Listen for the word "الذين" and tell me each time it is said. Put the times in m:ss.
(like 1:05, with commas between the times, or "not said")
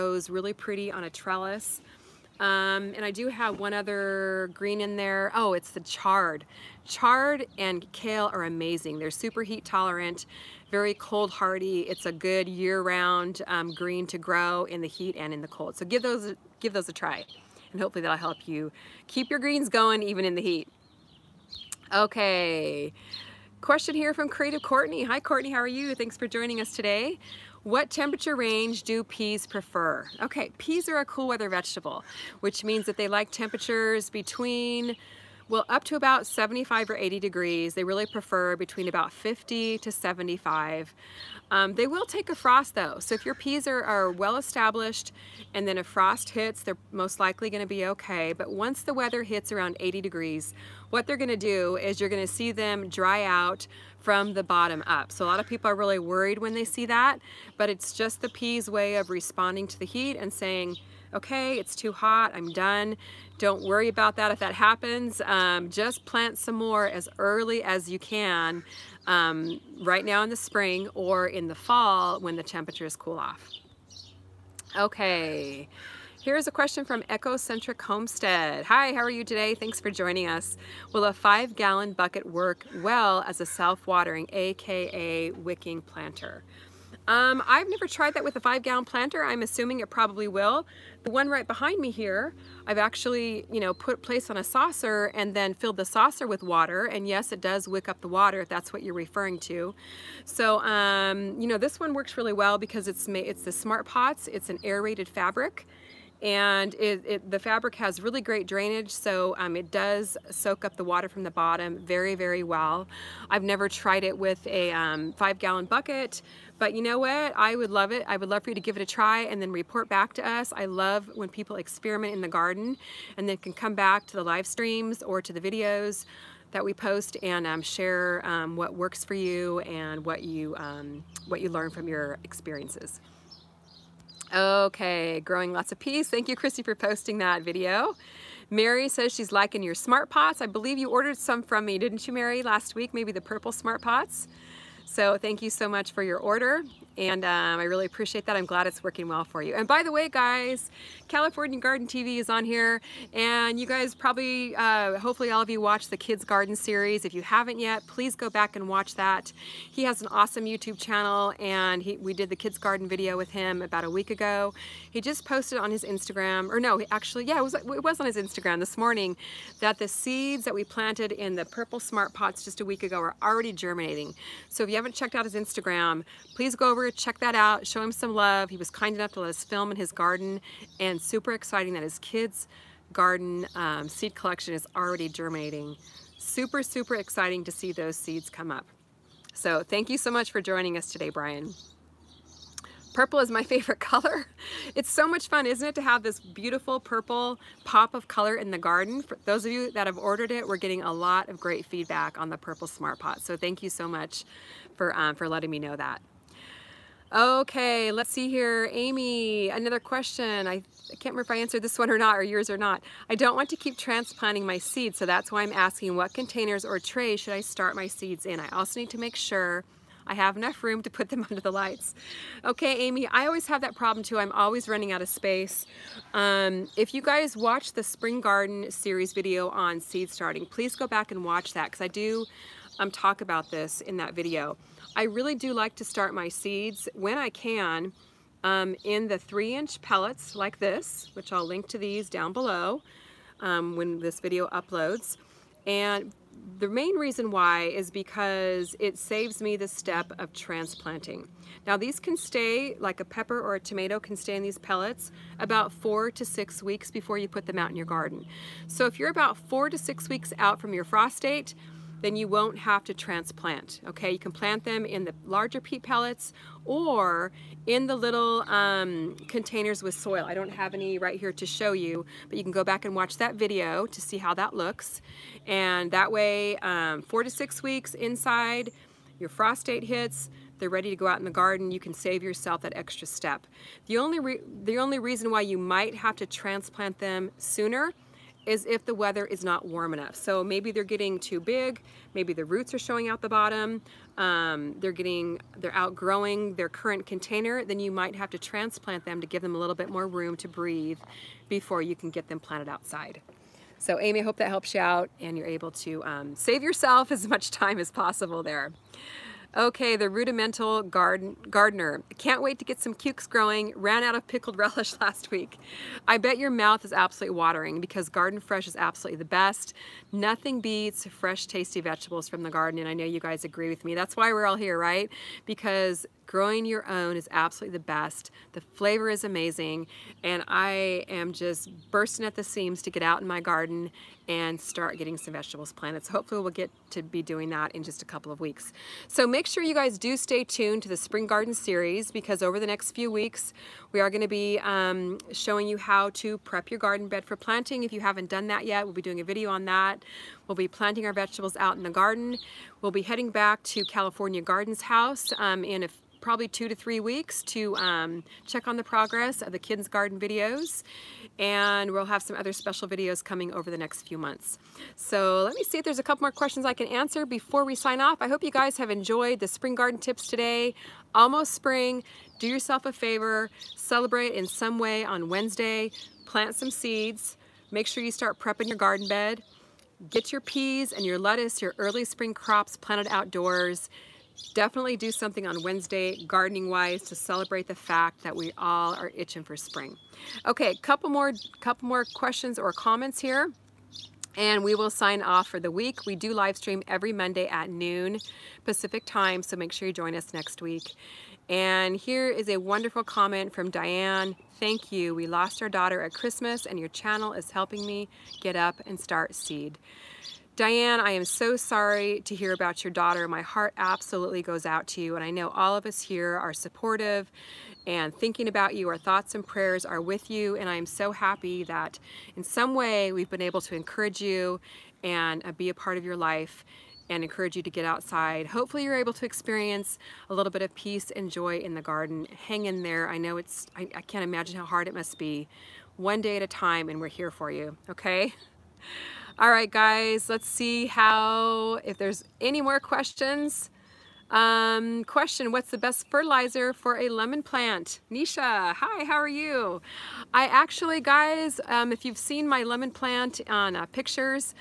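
not said.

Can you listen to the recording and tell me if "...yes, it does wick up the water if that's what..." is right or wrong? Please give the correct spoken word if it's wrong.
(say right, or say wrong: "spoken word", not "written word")
right.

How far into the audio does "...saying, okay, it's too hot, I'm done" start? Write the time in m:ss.
1:00.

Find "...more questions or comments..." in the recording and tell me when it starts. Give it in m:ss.
6:31.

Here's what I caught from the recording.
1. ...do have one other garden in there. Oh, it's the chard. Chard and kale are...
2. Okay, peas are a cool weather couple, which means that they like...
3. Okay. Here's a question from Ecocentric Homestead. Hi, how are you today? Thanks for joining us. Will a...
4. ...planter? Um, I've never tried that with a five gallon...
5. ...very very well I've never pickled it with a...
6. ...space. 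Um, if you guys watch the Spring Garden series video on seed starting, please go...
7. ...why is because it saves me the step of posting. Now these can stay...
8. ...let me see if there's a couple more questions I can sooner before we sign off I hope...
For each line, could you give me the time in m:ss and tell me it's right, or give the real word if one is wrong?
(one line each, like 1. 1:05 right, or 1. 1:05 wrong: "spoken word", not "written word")
1. 0:03 wrong: "green", not "garden"
2. 0:30 wrong: "vegetable", not "couple"
3. 1:14 right
4. 1:25 right
5. 1:51 wrong: "tried", not "pickled"
6. 3:45 right
7. 4:07 wrong: "transplanting", not "posting"
8. 6:05 wrong: "answer", not "sooner".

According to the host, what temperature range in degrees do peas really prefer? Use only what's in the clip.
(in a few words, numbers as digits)
50 to 75.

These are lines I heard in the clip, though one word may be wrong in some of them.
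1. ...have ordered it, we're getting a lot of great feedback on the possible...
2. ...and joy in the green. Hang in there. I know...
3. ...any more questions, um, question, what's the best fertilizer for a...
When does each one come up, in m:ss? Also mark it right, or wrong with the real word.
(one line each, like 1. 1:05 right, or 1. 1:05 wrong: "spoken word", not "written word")
1. 3:19 wrong: "purple", not "possible"
2. 7:11 wrong: "garden", not "green"
3. 7:22 right.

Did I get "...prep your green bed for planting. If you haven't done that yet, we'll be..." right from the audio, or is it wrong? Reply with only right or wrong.
wrong.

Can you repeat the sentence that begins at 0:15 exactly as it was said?
So give those, give those a try.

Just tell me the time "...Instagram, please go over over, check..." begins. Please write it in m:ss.
2:55.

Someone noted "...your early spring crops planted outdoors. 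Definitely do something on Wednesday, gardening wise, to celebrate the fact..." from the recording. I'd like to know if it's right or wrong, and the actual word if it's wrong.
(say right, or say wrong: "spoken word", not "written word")
right.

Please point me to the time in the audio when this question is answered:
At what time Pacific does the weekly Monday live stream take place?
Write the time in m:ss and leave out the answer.
6:37.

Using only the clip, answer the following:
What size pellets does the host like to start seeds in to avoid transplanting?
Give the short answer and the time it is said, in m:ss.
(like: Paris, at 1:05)
3 inch, at 3:59.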